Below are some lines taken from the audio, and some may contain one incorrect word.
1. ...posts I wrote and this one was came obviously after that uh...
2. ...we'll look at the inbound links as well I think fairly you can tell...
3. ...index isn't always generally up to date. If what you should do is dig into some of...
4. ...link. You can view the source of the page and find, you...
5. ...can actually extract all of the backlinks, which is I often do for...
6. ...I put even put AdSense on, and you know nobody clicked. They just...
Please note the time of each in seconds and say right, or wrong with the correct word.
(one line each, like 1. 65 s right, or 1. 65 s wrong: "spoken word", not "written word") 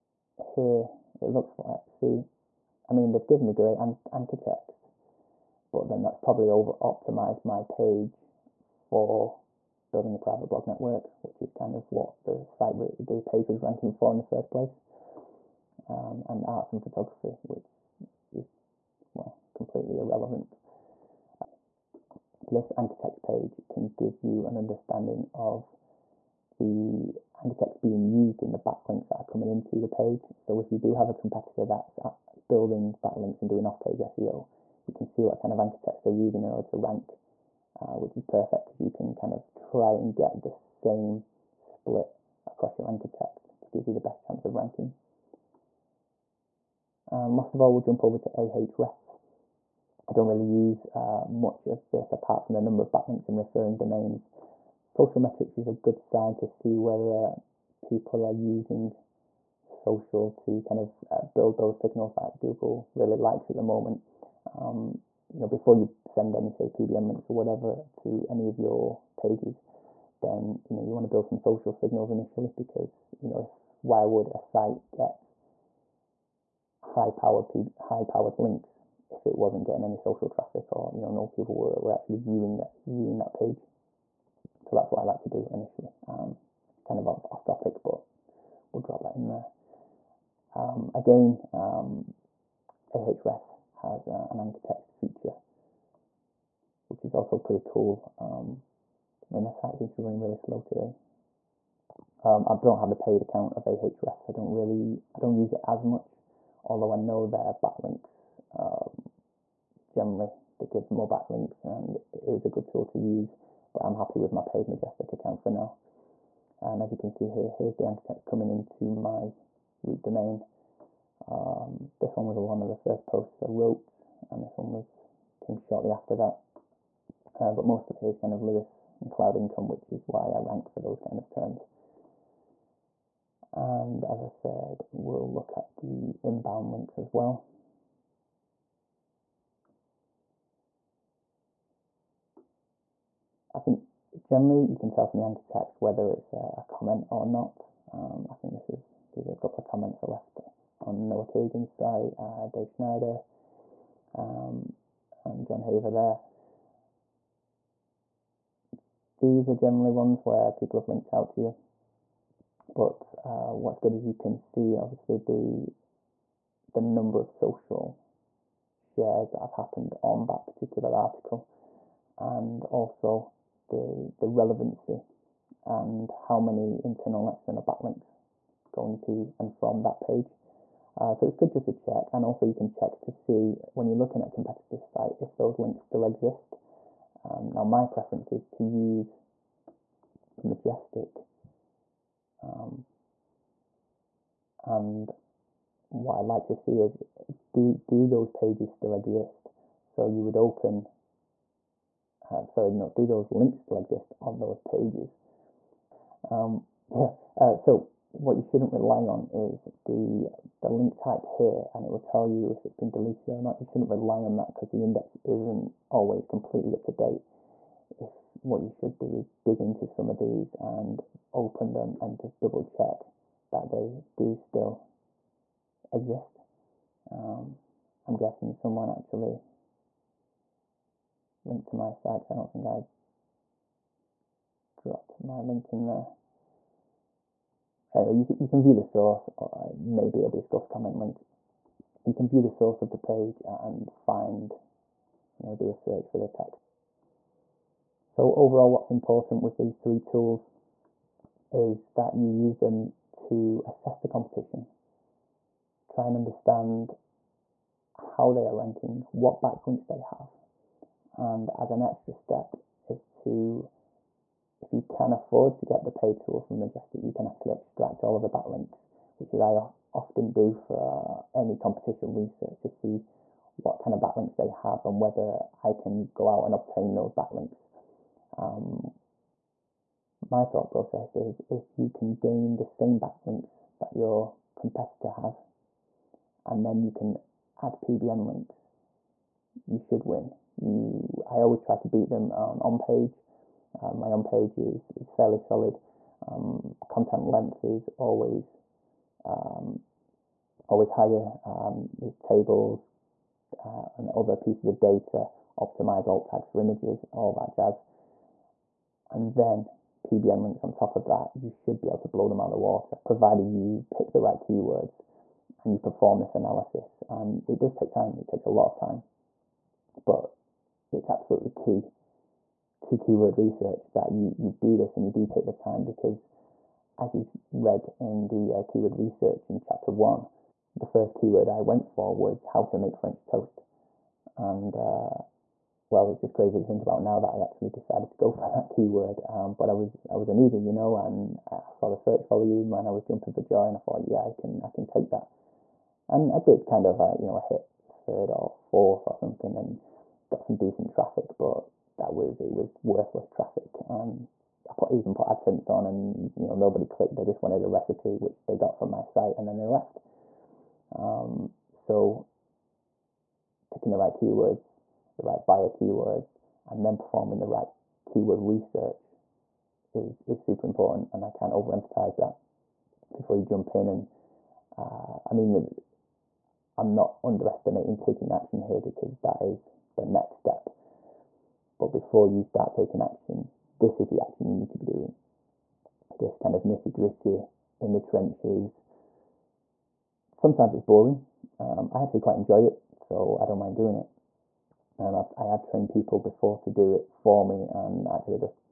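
1. 123 s wrong: "shortly", not "obviously"
2. 134 s wrong: "generally", not "fairly"
3. 214 s wrong: "completely", not "generally"
4. 240 s right
5. 267 s right
6. 354 s right.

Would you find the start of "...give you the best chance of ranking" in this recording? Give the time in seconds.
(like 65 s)
43 s.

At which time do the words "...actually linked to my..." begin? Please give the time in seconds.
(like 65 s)
228 s.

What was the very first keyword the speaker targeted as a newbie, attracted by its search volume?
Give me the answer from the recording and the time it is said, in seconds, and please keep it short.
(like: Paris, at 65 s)
how to make French toast, at 332 s.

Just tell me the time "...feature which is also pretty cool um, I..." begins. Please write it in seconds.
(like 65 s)
94 s.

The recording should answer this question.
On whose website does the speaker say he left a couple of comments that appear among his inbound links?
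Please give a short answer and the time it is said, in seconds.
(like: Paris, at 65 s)
Noah Kagan, at 151 s.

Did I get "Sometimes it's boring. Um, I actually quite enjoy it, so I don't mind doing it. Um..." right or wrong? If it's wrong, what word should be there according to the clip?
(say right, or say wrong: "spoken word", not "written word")
right.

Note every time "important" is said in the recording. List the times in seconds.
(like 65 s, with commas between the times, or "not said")
248 s, 370 s.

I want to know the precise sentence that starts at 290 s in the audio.
You, I always try to beat them on on page.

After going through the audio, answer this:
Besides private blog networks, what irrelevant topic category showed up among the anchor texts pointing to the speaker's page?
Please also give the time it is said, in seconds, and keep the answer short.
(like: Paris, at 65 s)
arts and photography, at 16 s.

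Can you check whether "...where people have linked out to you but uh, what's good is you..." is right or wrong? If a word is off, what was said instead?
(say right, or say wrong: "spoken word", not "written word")
right.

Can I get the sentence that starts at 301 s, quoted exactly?
Um, there's tables uh, and other pieces of data, optimize alt tags for images, all that jazz.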